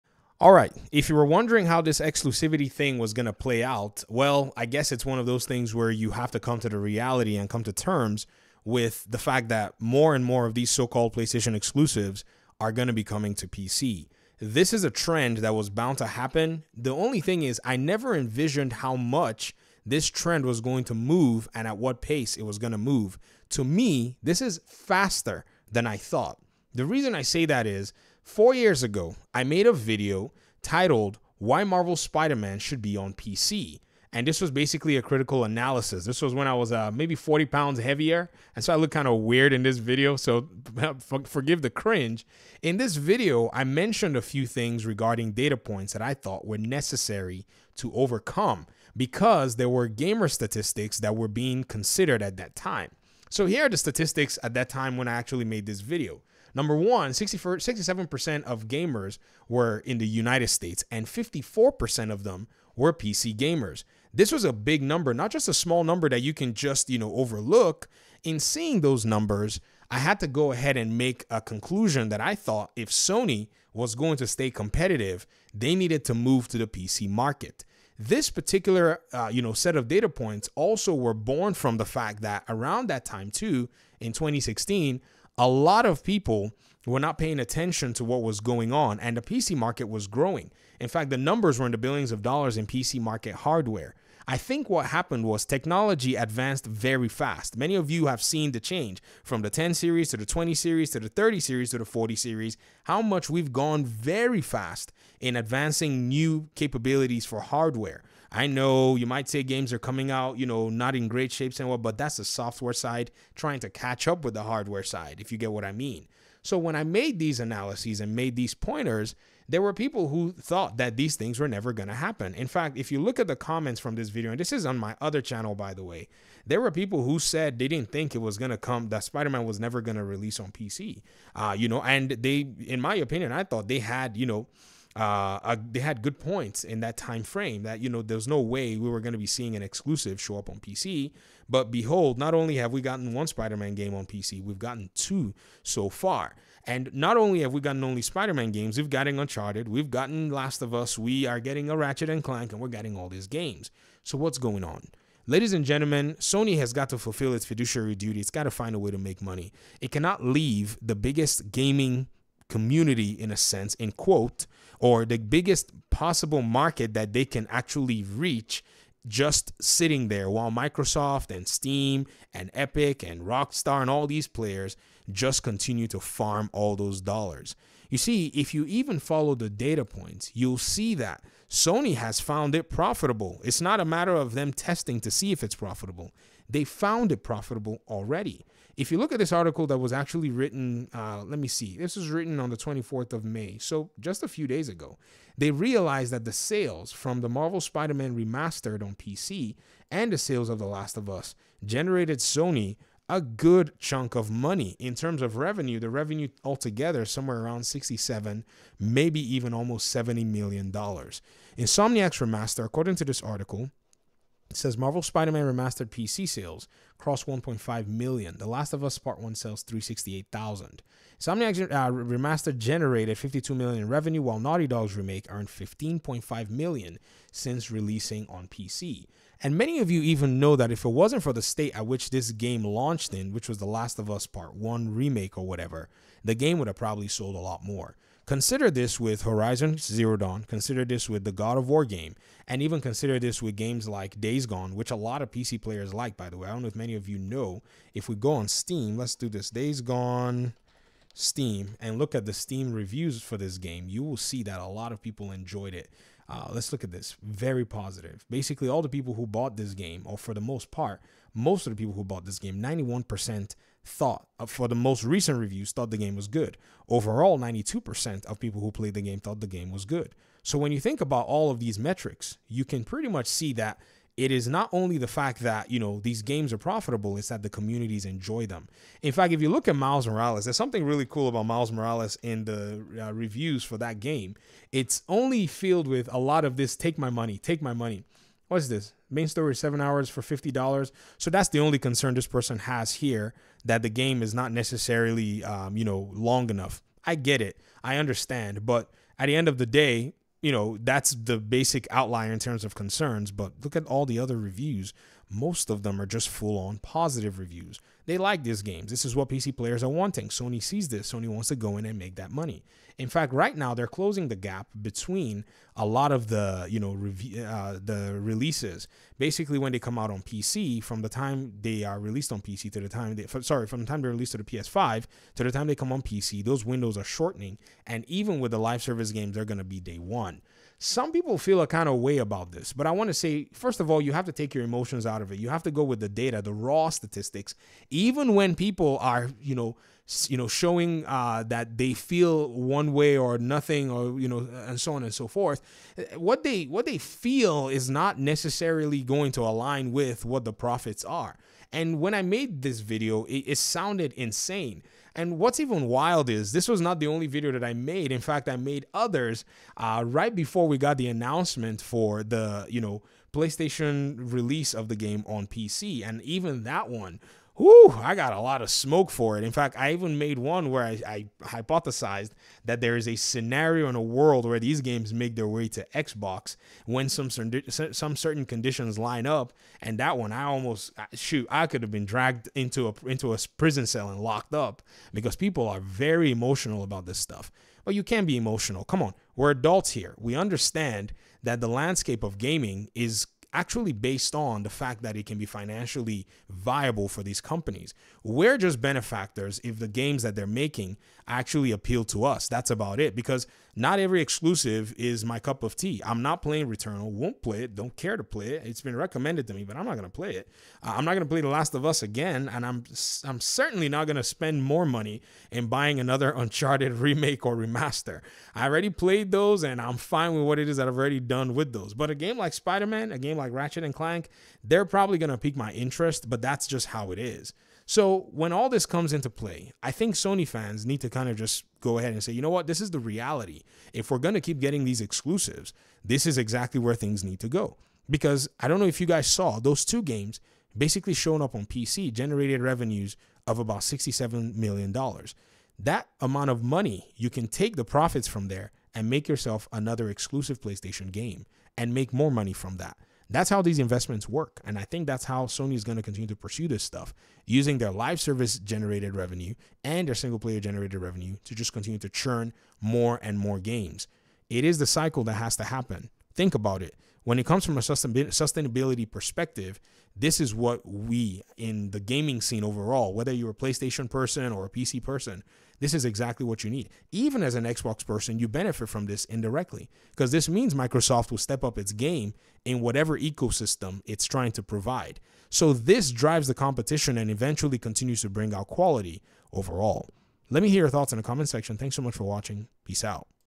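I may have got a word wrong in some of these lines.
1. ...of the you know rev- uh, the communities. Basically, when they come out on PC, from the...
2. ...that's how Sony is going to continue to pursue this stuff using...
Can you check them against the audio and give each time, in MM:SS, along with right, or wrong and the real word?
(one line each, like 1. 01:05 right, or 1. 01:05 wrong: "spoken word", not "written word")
1. 05:16 wrong: "releases", not "communities"
2. 07:35 right.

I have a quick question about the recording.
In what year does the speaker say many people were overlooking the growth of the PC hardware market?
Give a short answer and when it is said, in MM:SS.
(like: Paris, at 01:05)
2016, at 01:24.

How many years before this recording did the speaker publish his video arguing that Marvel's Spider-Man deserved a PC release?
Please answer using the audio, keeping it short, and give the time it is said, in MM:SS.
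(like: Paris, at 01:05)
4, at 00:28.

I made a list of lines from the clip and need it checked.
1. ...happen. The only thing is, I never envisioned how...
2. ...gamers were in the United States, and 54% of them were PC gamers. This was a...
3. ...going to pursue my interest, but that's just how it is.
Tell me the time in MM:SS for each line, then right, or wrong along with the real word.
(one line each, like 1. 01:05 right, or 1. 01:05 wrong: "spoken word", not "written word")
1. 00:16 right
2. 00:58 right
3. 07:05 wrong: "pique", not "pursue".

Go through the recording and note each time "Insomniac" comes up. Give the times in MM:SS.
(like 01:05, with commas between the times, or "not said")
03:31, 03:41.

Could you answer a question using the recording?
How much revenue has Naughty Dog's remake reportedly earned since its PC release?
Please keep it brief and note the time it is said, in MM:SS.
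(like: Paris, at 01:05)
15.5 million, at 03:45.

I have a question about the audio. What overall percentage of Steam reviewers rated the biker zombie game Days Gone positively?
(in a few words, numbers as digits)
92%.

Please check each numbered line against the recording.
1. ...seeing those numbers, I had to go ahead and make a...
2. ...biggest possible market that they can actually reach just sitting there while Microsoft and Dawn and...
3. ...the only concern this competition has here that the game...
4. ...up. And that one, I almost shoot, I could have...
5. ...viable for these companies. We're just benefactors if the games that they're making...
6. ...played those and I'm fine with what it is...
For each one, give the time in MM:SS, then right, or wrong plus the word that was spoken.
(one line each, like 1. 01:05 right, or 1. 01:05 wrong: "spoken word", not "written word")
1. 01:08 right
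2. 02:45 wrong: "Steam", not "Dawn"
3. 04:51 wrong: "person", not "competition"
4. 06:19 right
5. 06:36 right
6. 06:58 right.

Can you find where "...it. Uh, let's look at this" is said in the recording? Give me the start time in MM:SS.
04:15.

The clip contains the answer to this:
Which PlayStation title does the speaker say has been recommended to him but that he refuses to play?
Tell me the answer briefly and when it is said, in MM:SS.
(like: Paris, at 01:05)
Returnal, at 06:46.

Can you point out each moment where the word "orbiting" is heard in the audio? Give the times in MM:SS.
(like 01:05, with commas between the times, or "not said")
not said.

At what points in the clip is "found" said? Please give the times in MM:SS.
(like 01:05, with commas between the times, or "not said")
03:02, 03:06.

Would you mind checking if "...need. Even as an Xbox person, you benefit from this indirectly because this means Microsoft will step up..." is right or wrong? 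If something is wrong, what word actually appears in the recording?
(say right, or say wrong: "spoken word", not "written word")
right.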